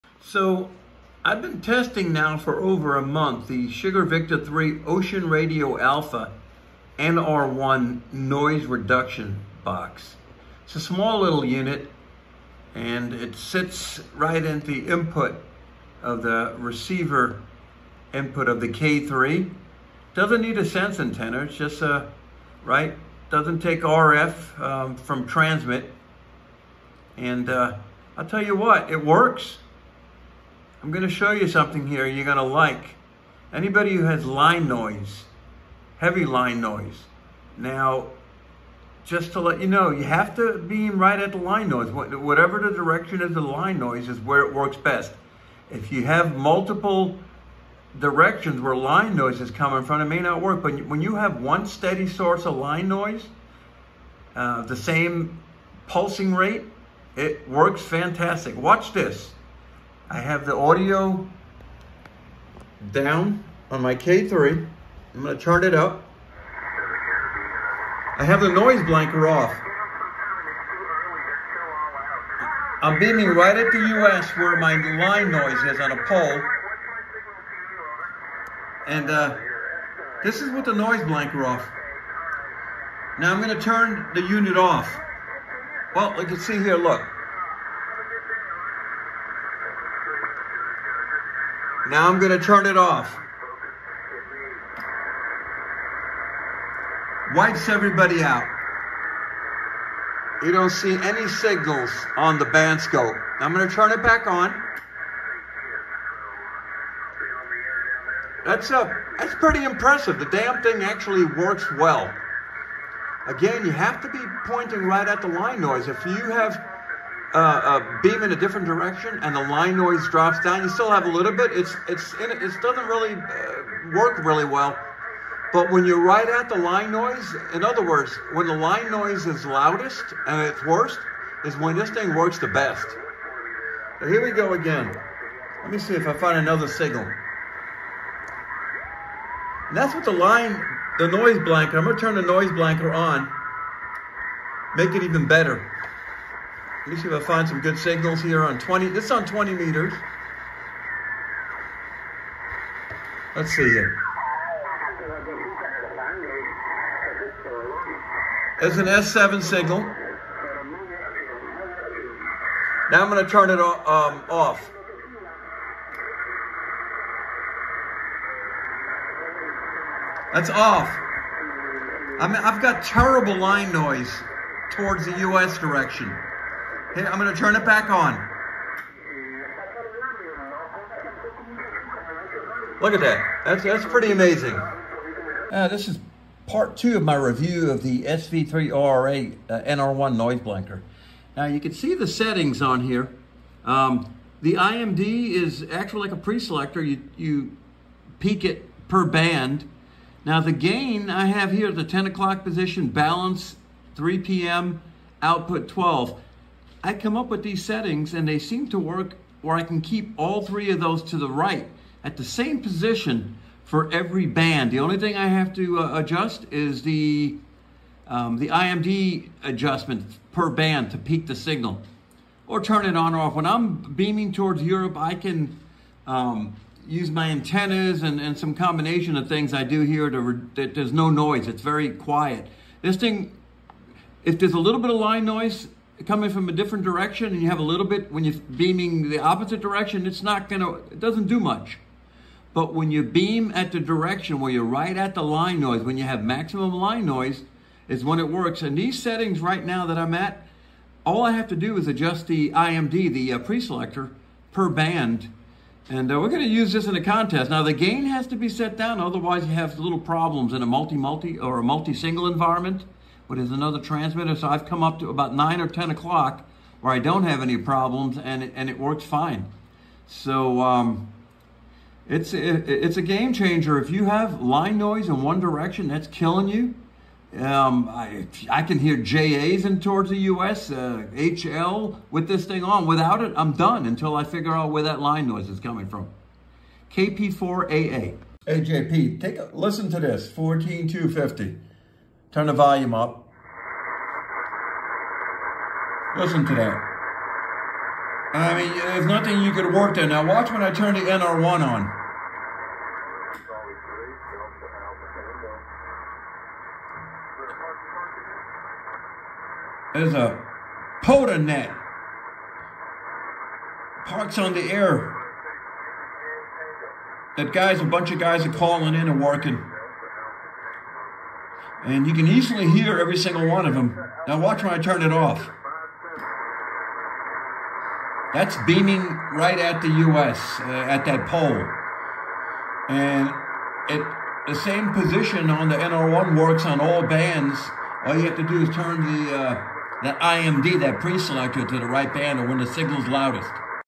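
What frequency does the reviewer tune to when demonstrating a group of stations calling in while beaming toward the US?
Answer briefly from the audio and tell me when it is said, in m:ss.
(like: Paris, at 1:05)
14250, at 4:50.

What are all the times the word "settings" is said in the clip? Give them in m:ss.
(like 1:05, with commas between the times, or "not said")
3:12, 3:27, 4:09.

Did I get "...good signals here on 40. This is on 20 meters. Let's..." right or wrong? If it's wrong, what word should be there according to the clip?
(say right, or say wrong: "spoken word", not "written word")
wrong: "20", not "40".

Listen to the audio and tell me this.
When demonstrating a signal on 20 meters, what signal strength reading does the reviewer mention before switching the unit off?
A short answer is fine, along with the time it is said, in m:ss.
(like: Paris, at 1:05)
S7, at 2:38.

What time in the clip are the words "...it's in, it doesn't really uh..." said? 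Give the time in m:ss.
2:01.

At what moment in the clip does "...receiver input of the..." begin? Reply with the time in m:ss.
0:16.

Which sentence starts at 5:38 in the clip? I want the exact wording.
All you have to do is turn the uh, that IMD, that preselector, to the right band or when the signal's loudest.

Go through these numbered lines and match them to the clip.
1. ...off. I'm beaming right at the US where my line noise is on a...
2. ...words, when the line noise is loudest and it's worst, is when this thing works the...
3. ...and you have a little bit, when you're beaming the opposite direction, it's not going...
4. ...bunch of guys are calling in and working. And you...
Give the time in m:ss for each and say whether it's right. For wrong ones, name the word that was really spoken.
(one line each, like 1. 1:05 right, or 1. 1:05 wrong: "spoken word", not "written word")
1. 1:09 right
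2. 2:07 right
3. 3:57 right
4. 5:17 right.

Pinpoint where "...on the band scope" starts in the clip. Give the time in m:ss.
1:42.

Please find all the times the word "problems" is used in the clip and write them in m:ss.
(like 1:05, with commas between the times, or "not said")
4:19, 4:27.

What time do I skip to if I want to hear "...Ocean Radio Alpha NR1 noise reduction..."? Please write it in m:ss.
0:04.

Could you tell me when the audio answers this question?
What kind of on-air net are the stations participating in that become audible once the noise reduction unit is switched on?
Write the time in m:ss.
5:14.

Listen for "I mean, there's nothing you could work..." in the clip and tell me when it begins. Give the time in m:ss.
4:58.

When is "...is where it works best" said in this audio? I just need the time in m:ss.
0:44.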